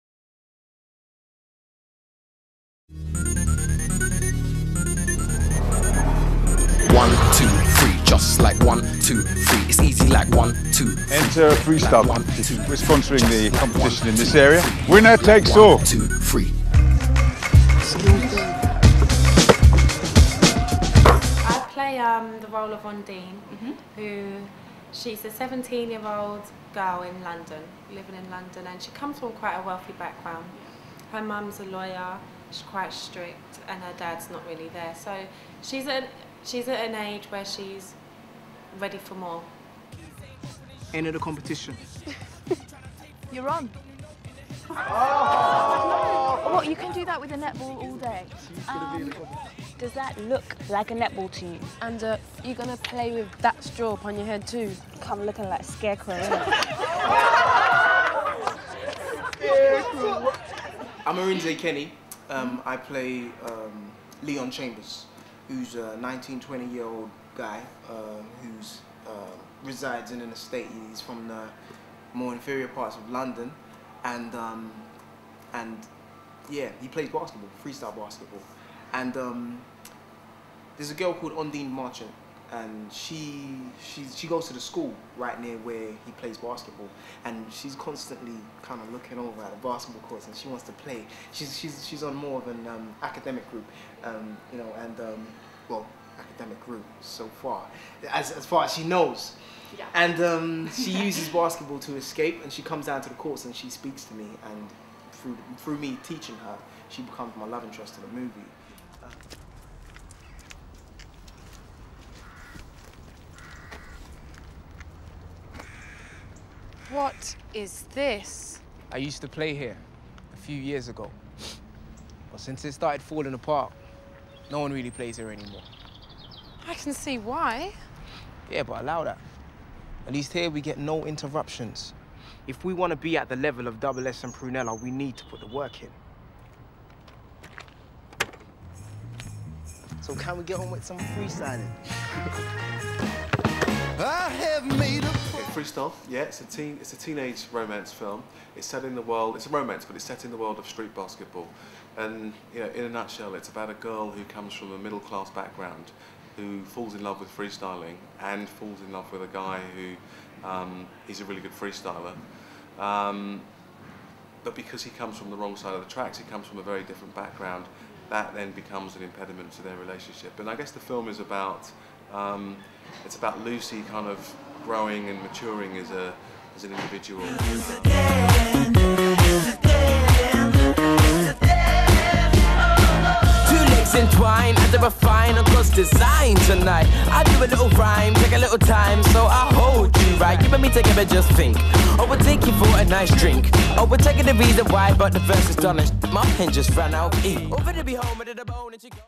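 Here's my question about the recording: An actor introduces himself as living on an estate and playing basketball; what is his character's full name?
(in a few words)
Leon Chambers.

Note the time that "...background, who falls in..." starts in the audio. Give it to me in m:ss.
2:35.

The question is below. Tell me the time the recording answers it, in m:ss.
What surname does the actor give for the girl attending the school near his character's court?
1:21.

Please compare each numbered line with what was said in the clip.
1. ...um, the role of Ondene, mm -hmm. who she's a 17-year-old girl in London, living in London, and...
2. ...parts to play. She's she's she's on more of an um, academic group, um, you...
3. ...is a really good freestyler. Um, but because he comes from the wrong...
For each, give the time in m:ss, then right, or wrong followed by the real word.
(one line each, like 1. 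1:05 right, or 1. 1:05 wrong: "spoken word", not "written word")
1. 0:21 right
2. 1:30 wrong: "wants", not "parts"
3. 2:41 right.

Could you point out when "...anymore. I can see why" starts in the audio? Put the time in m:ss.
2:05.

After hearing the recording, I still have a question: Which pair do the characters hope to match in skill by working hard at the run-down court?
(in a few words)
Double S and Prunella.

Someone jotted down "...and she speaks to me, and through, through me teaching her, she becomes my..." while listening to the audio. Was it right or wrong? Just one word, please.
right.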